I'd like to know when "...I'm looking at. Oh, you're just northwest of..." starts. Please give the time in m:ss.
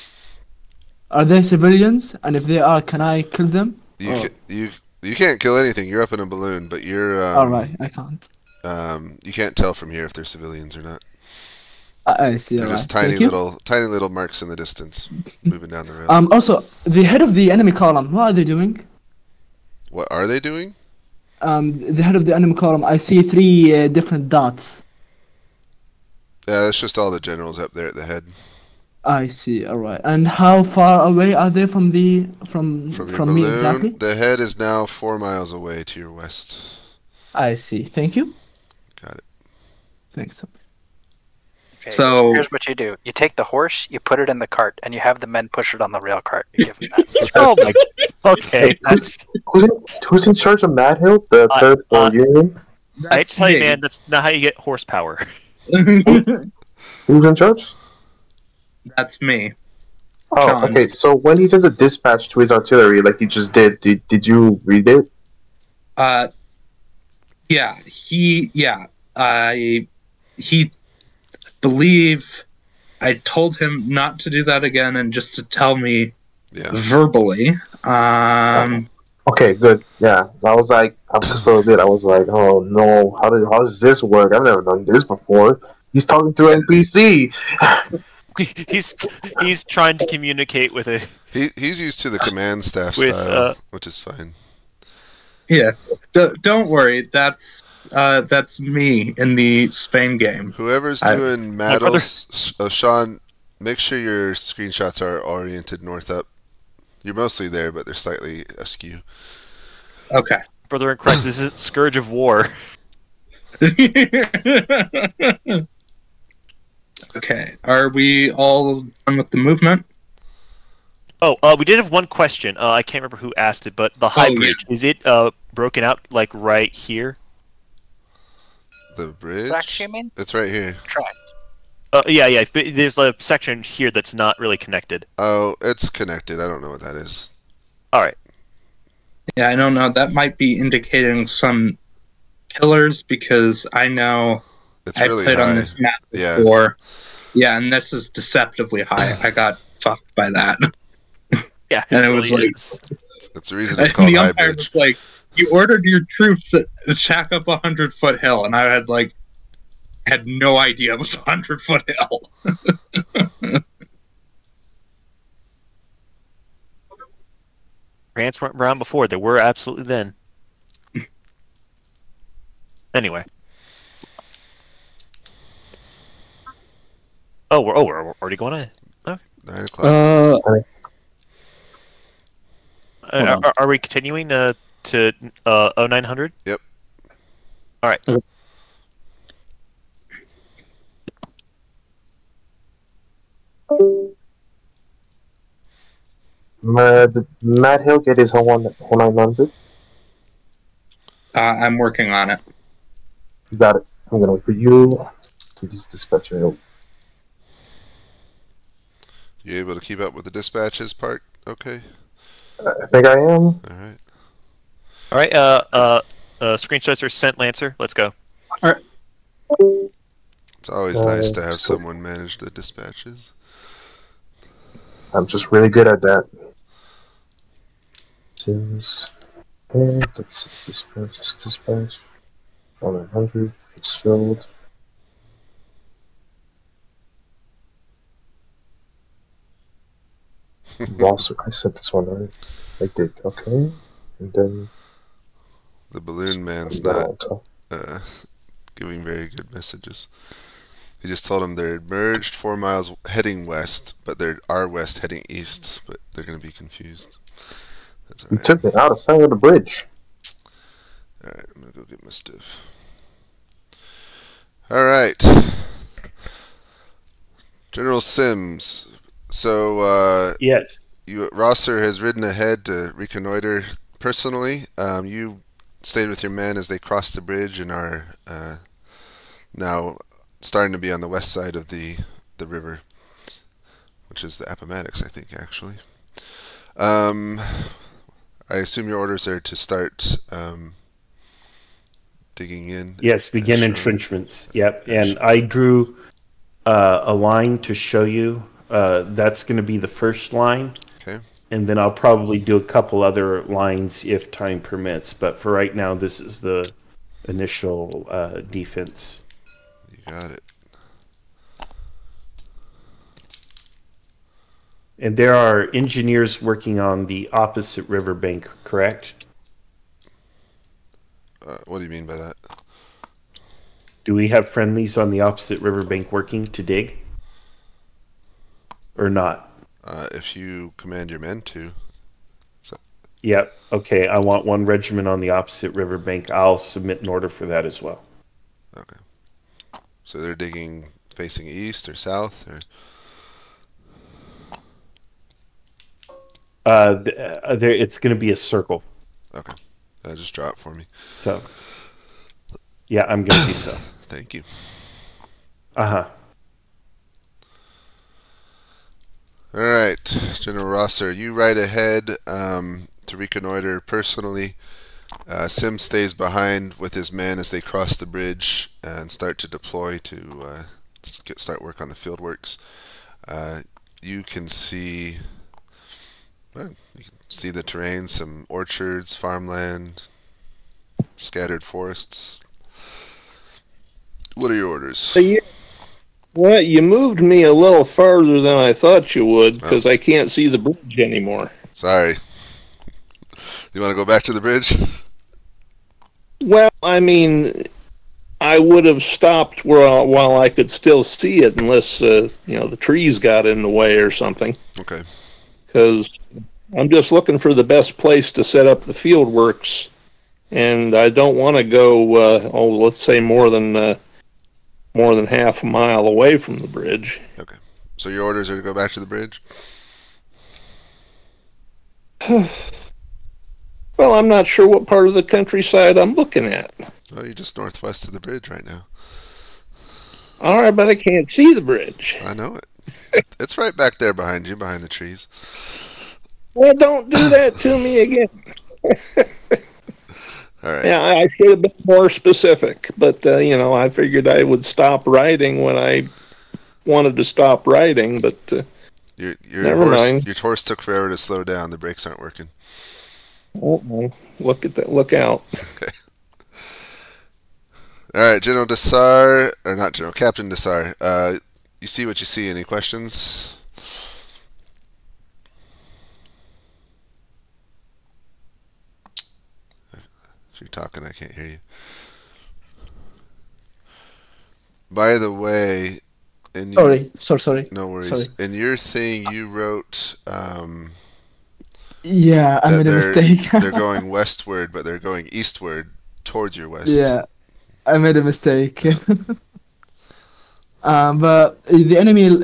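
7:05.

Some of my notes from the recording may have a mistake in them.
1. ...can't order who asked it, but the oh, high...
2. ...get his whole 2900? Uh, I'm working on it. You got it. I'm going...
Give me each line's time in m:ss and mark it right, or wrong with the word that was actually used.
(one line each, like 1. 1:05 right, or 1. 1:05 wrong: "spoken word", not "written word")
1. 2:02 wrong: "remember", not "order"
2. 3:18 wrong: "0900", not "2900".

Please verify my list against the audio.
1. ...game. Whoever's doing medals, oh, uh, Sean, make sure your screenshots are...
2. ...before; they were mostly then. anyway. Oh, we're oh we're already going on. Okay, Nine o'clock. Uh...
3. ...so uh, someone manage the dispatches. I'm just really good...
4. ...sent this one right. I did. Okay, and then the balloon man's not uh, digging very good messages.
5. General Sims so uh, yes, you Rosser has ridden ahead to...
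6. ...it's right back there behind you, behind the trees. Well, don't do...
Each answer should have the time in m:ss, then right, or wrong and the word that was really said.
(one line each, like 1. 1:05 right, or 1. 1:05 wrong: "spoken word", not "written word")
1. 1:40 right
2. 2:48 wrong: "absolutely", not "mostly"
3. 3:41 right
4. 4:01 wrong: "giving", not "digging"
5. 4:27 right
6. 7:13 right.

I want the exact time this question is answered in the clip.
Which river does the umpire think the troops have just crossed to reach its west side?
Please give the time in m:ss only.
4:44.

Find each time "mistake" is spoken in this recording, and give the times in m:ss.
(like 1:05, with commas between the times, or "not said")
8:02, 8:08.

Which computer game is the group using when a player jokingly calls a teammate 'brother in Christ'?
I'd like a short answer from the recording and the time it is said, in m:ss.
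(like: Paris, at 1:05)
Scourge of War, at 1:51.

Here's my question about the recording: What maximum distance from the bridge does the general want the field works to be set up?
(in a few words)
Half a mile.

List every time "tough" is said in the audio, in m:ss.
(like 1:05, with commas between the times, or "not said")
not said.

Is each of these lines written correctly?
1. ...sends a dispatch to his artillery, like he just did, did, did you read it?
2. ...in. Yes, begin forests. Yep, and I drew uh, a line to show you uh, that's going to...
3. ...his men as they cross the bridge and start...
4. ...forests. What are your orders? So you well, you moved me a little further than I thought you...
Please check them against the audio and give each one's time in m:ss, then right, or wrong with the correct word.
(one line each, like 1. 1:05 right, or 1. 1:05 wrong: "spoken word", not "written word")
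1. 1:01 right
2. 4:52 wrong: "entrenchments", not "forests"
3. 6:06 right
4. 6:21 right.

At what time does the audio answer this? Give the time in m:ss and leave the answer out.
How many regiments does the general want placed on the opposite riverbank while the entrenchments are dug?
5:34.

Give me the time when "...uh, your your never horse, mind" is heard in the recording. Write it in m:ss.
7:28.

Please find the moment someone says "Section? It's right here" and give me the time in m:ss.
2:09.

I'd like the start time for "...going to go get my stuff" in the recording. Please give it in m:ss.
4:21.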